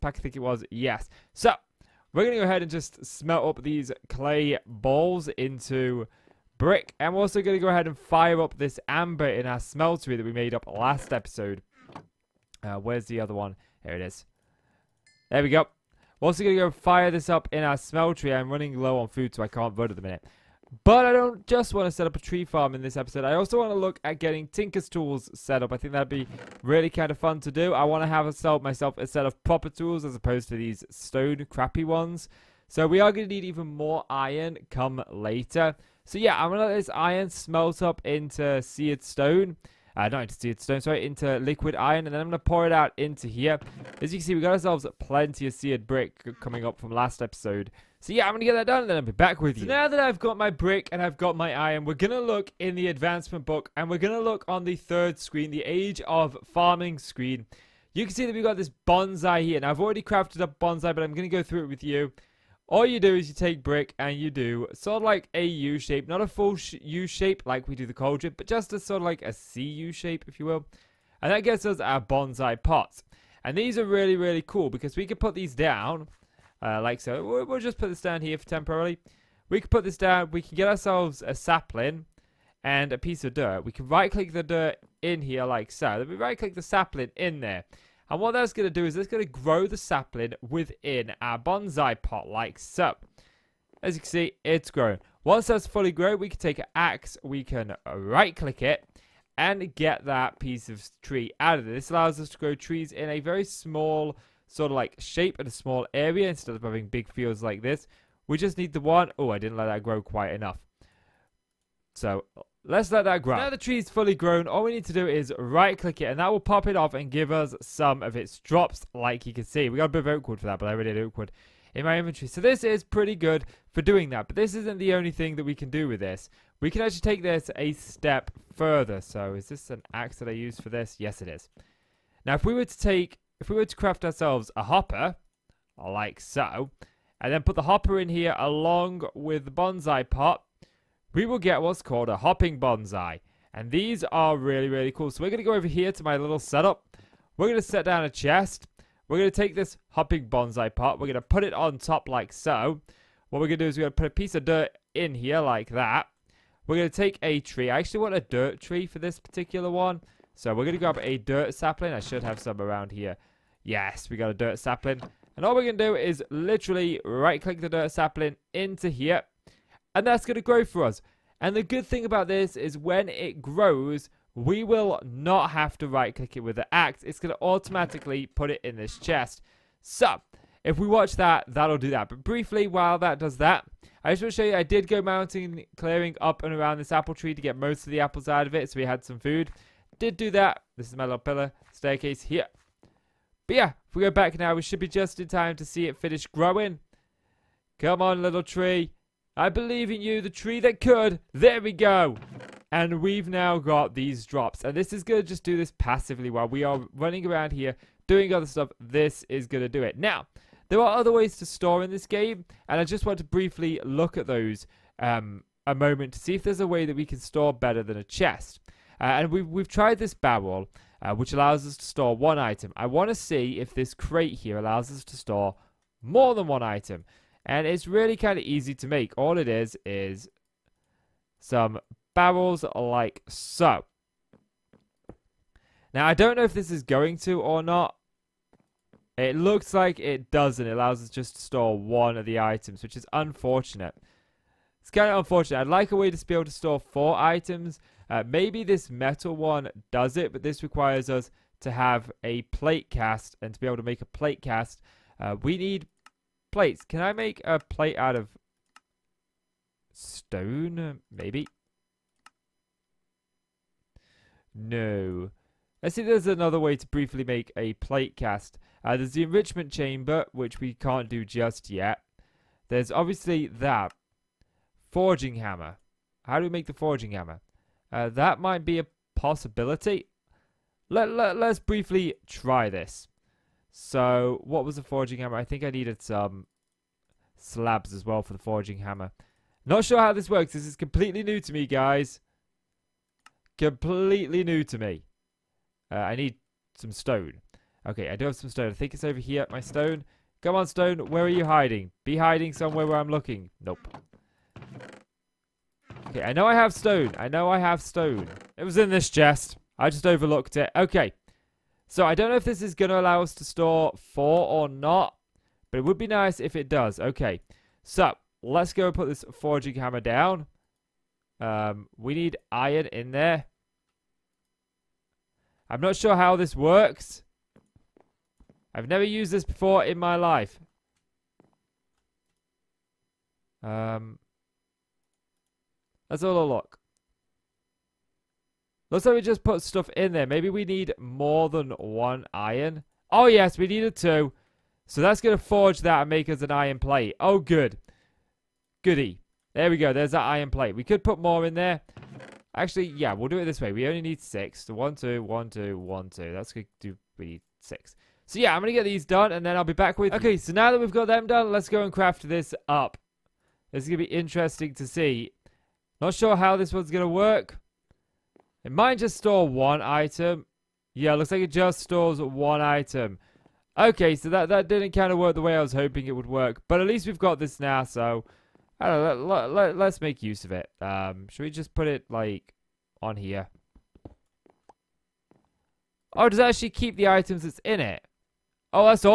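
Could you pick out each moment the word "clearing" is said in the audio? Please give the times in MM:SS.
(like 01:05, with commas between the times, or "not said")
03:05.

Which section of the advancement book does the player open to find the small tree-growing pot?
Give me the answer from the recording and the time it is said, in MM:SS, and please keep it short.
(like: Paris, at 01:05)
Age of farming, at 00:55.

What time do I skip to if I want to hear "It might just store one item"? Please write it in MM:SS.
06:08.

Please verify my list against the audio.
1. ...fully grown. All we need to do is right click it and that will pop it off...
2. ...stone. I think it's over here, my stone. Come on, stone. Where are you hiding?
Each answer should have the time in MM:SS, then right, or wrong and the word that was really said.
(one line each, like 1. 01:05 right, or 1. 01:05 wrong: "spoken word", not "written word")
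1. 01:53 right
2. 04:58 right.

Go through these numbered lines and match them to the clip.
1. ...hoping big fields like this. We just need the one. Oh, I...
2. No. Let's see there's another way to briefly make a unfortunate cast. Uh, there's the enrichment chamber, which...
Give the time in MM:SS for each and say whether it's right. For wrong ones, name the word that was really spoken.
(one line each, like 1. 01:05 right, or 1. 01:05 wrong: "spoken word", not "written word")
1. 01:46 wrong: "having", not "hoping"
2. 04:24 wrong: "plate", not "unfortunate".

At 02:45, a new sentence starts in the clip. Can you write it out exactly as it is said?
And all we're going to do is literally right-click the dirt sapling into here.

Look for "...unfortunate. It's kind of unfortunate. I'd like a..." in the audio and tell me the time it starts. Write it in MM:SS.
04:03.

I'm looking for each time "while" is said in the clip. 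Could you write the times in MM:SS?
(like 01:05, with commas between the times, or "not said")
03:02, 03:26.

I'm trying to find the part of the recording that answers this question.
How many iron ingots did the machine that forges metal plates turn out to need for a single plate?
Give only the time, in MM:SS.
05:43.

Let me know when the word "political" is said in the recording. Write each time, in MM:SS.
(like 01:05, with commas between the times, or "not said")
not said.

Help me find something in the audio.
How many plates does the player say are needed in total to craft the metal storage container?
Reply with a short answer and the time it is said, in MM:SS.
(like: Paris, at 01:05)
6, at 05:53.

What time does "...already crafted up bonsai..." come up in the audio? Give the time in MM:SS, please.
00:59.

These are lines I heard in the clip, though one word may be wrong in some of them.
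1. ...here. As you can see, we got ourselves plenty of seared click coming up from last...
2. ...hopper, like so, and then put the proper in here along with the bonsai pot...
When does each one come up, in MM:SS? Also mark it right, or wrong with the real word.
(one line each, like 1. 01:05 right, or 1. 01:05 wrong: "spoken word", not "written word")
1. 00:43 wrong: "brick", not "click"
2. 02:14 wrong: "hopper", not "proper".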